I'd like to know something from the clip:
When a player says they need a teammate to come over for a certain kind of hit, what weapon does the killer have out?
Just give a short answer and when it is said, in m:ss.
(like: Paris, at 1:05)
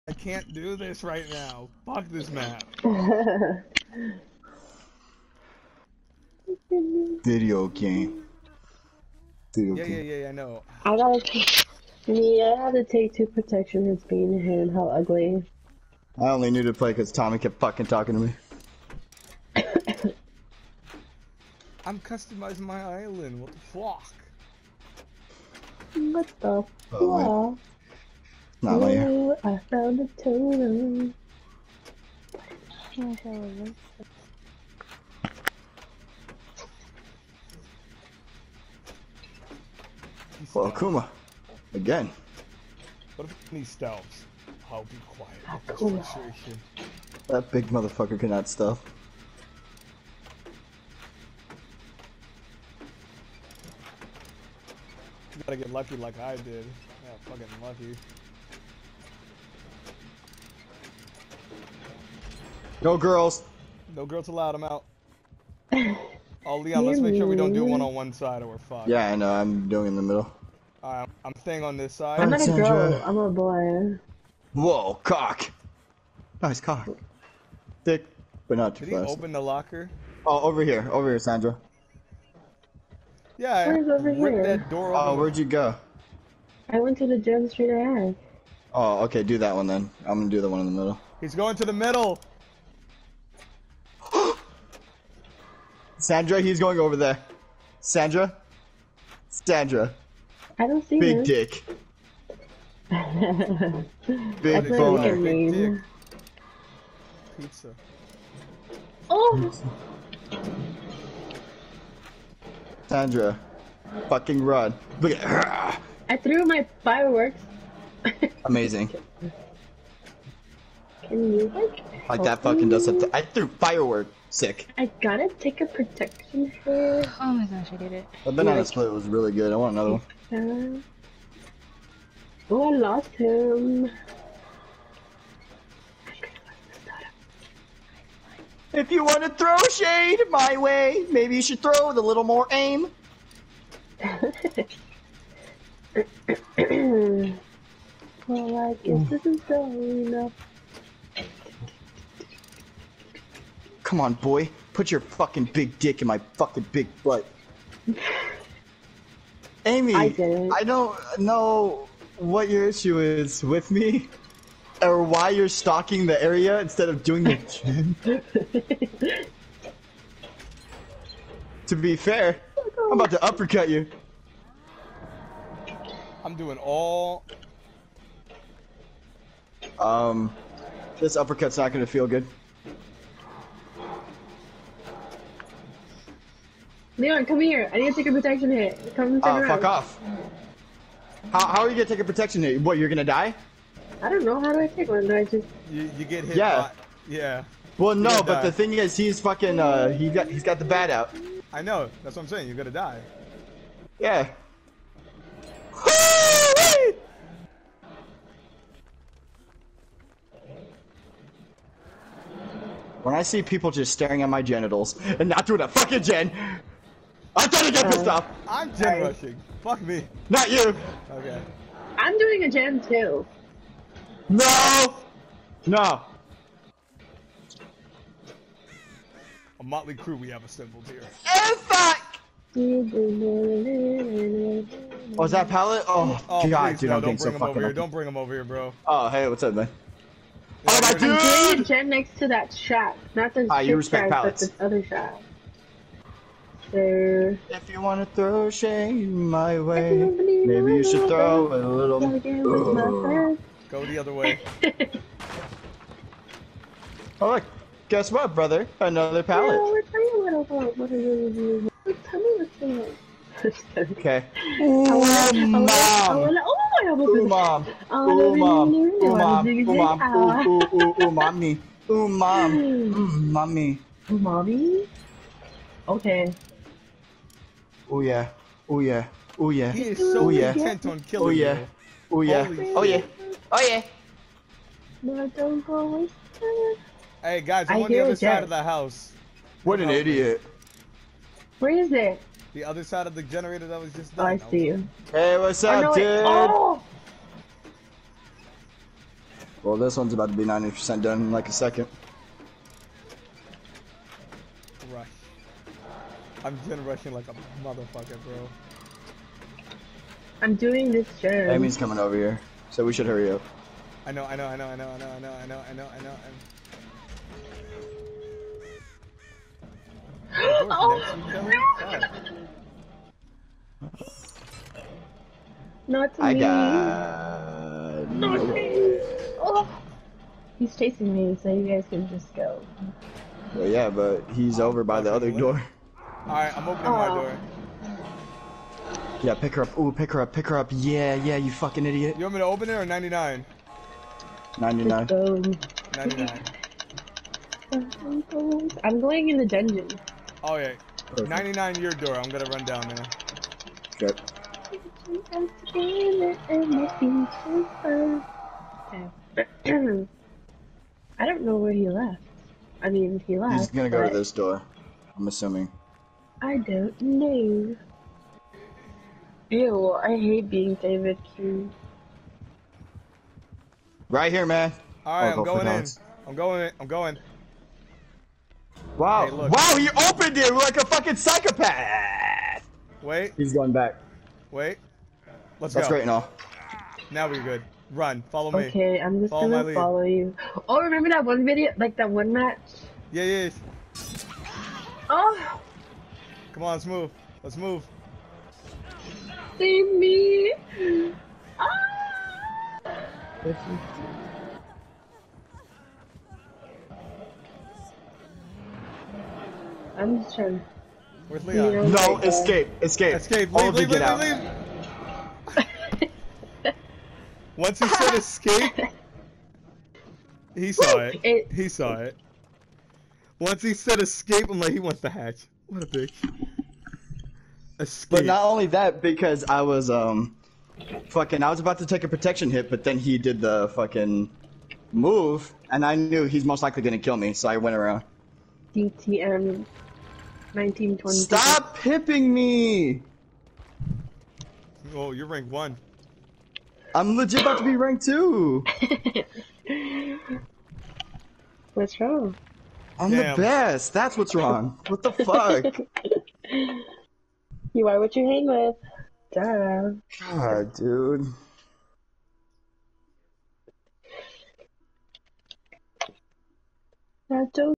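bat, at 3:20.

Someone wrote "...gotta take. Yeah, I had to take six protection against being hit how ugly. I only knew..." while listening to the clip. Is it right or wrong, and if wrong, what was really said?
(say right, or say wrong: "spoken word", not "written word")
wrong: "two", not "six".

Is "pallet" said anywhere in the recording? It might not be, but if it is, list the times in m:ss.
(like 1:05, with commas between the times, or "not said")
3:55, 4:04, 4:19.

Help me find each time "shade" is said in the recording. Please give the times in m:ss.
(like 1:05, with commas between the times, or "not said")
2:19, 4:08.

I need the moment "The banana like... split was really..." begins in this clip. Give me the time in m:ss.
2:08.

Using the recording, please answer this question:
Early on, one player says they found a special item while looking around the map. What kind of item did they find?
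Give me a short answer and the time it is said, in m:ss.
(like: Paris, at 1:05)
totem, at 0:30.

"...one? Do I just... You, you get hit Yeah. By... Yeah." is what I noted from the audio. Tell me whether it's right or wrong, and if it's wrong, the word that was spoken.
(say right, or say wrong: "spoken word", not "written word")
right.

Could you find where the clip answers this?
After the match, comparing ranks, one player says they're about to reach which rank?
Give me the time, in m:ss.
7:27.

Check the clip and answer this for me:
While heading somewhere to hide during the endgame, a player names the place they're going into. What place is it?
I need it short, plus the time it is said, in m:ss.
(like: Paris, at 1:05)
the dungeon, at 5:49.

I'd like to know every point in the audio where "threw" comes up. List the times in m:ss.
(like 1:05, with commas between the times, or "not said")
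1:56, 2:03.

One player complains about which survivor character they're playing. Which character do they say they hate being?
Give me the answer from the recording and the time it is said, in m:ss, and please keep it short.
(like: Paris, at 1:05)
David, at 6:10.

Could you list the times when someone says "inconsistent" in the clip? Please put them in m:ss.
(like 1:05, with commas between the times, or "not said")
not said.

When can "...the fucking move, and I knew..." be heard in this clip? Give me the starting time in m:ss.
7:13.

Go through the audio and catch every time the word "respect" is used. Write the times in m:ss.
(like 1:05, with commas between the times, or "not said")
4:03.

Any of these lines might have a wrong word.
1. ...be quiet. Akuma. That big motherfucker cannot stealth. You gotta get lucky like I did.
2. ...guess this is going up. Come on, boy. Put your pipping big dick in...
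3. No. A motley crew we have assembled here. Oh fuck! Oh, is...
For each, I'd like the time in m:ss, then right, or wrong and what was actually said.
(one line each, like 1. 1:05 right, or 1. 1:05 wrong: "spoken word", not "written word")
1. 0:44 right
2. 2:28 wrong: "fucking", not "pipping"
3. 3:45 right.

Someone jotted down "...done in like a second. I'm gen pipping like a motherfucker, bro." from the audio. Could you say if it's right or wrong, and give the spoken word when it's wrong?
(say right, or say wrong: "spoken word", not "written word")
wrong: "rushing", not "pipping".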